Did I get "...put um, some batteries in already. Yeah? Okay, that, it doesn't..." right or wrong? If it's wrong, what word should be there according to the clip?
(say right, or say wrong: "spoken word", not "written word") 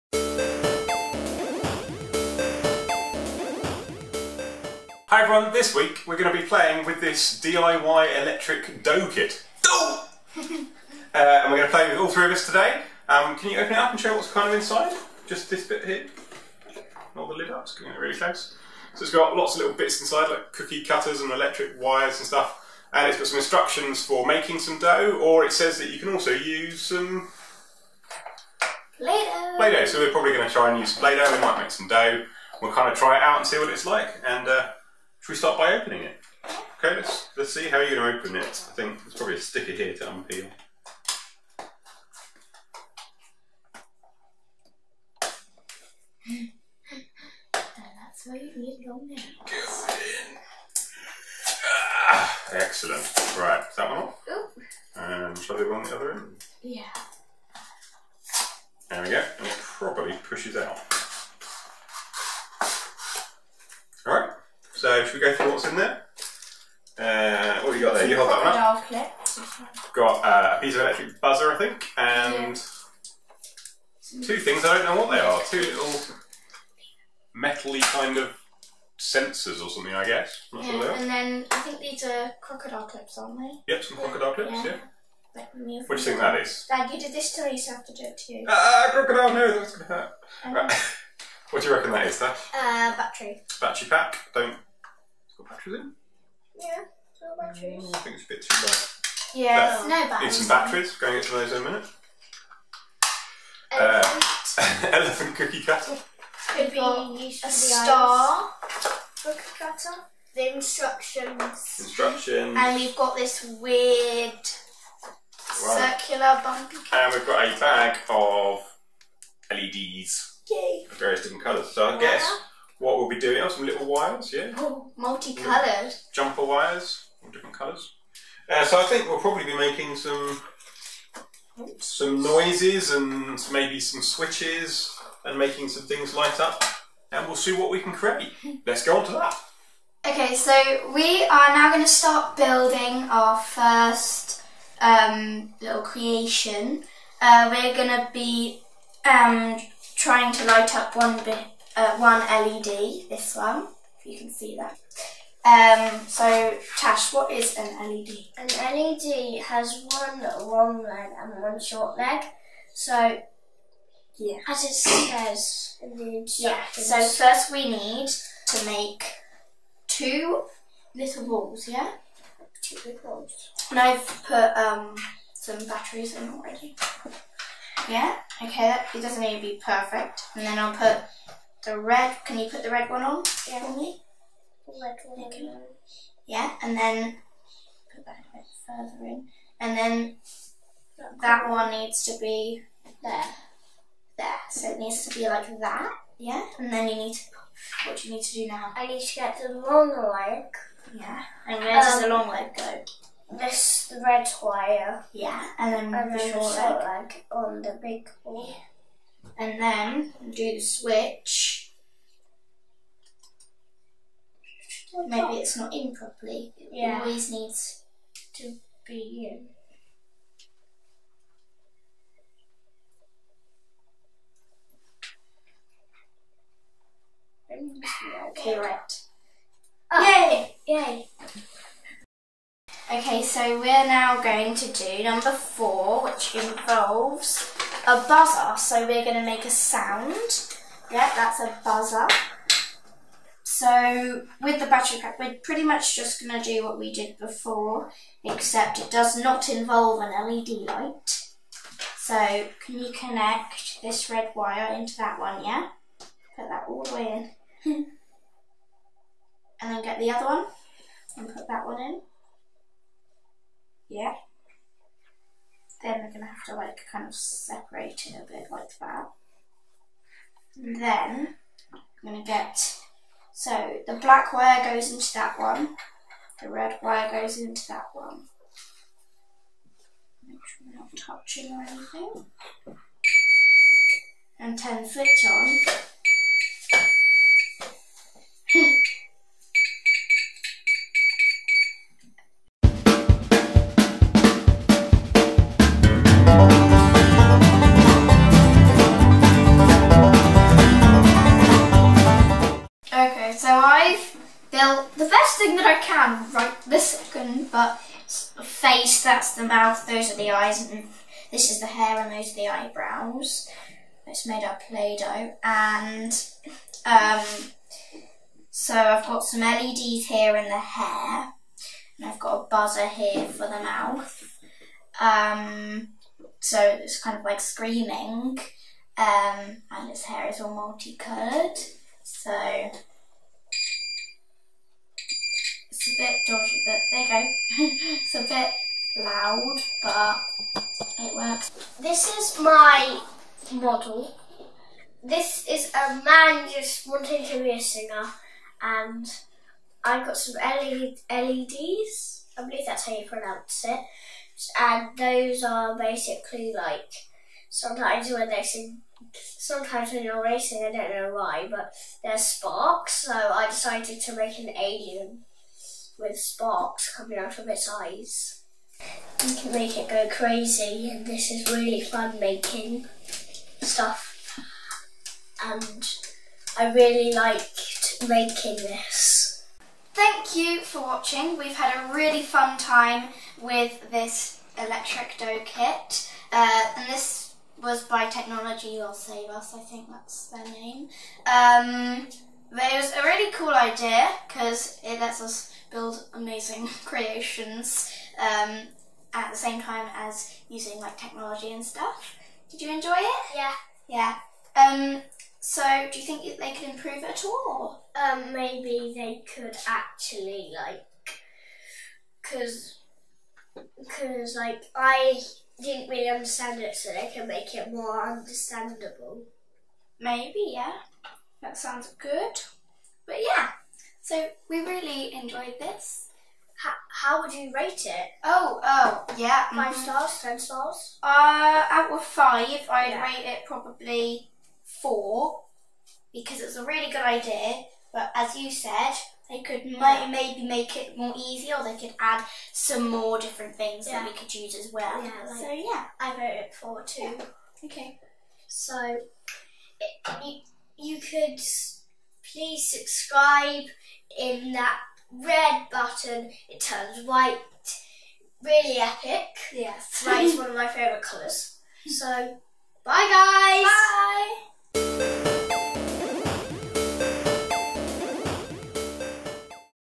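right.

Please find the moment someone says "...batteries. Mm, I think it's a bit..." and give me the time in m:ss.
1:37.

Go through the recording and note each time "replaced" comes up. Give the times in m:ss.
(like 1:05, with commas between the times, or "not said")
not said.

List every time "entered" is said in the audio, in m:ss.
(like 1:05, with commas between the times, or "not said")
not said.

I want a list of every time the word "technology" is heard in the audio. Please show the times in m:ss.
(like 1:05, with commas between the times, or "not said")
6:28, 6:40.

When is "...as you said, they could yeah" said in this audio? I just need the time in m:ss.
7:18.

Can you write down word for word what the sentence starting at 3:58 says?
So we're going to make a sound.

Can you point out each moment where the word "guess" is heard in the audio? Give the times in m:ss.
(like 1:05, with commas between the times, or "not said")
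1:20, 2:01.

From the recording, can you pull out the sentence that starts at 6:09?
You can make it go crazy and this is really fun making stuff and I really liked making this.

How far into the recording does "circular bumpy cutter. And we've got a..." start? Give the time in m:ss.
1:55.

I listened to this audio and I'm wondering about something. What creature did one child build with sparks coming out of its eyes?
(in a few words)
An alien.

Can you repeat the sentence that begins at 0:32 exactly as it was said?
We'll kind of try it out and see what it's like, and uh, should we start by opening it?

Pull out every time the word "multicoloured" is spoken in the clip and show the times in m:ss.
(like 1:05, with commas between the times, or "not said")
2:04, 5:30.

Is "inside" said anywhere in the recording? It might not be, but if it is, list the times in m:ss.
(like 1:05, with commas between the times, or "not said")
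0:14, 0:19.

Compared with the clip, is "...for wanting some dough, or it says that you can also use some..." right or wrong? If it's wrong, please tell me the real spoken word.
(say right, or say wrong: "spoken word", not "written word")
wrong: "making", not "wanting".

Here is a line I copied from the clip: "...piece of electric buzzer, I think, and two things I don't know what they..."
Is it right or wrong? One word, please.
right.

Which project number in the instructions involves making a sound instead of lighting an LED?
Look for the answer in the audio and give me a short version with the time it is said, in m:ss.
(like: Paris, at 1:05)
4, at 3:55.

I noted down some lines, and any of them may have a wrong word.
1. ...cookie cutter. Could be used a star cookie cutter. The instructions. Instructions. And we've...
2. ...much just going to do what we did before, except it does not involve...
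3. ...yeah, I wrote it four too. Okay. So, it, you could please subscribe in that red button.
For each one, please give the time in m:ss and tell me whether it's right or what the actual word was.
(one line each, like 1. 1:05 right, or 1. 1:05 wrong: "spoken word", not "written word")
1. 1:45 right
2. 4:05 right
3. 7:25 right.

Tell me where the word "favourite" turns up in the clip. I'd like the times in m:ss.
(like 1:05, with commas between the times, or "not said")
7:40.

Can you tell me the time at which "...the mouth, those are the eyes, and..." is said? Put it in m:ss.
5:09.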